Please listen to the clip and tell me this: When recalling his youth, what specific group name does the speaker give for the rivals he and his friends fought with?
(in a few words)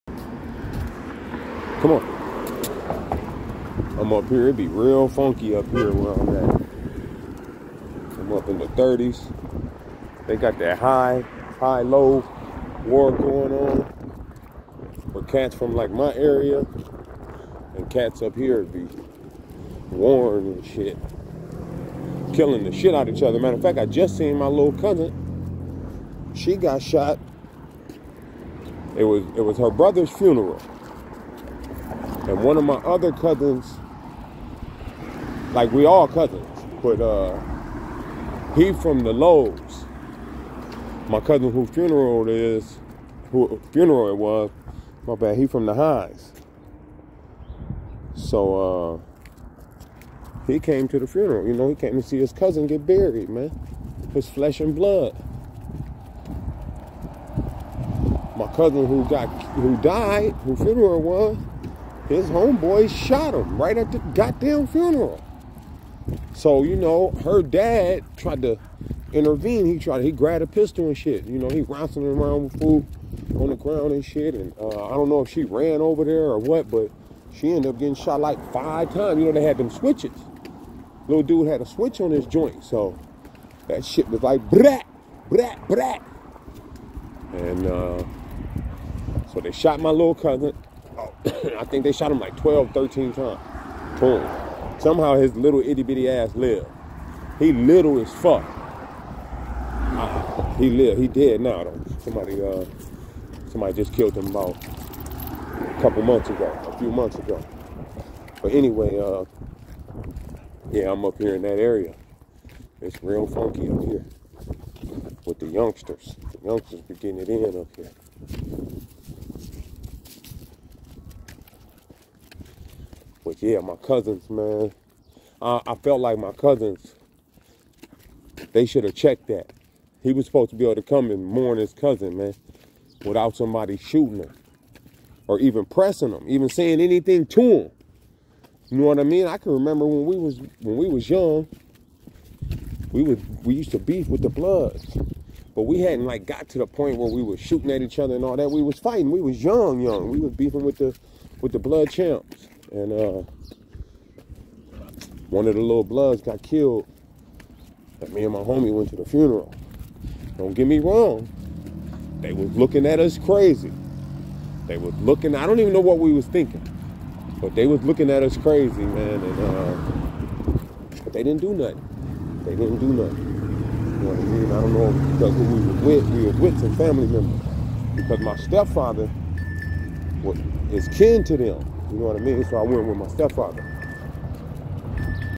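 blood champs.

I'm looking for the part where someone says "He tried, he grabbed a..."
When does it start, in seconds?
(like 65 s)
69 s.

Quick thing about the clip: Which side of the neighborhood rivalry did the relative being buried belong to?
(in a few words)
the Highs.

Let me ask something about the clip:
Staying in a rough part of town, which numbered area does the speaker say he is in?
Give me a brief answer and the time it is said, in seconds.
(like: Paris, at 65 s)
the 30s, at 8 s.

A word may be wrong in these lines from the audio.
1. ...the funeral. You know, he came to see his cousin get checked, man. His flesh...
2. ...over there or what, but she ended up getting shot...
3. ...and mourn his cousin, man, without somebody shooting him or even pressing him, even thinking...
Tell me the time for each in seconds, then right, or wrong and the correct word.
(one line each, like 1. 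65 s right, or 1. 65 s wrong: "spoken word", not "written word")
1. 50 s wrong: "buried", not "checked"
2. 75 s right
3. 131 s wrong: "saying", not "thinking".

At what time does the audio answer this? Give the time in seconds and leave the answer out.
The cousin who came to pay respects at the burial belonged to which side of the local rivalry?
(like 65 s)
39 s.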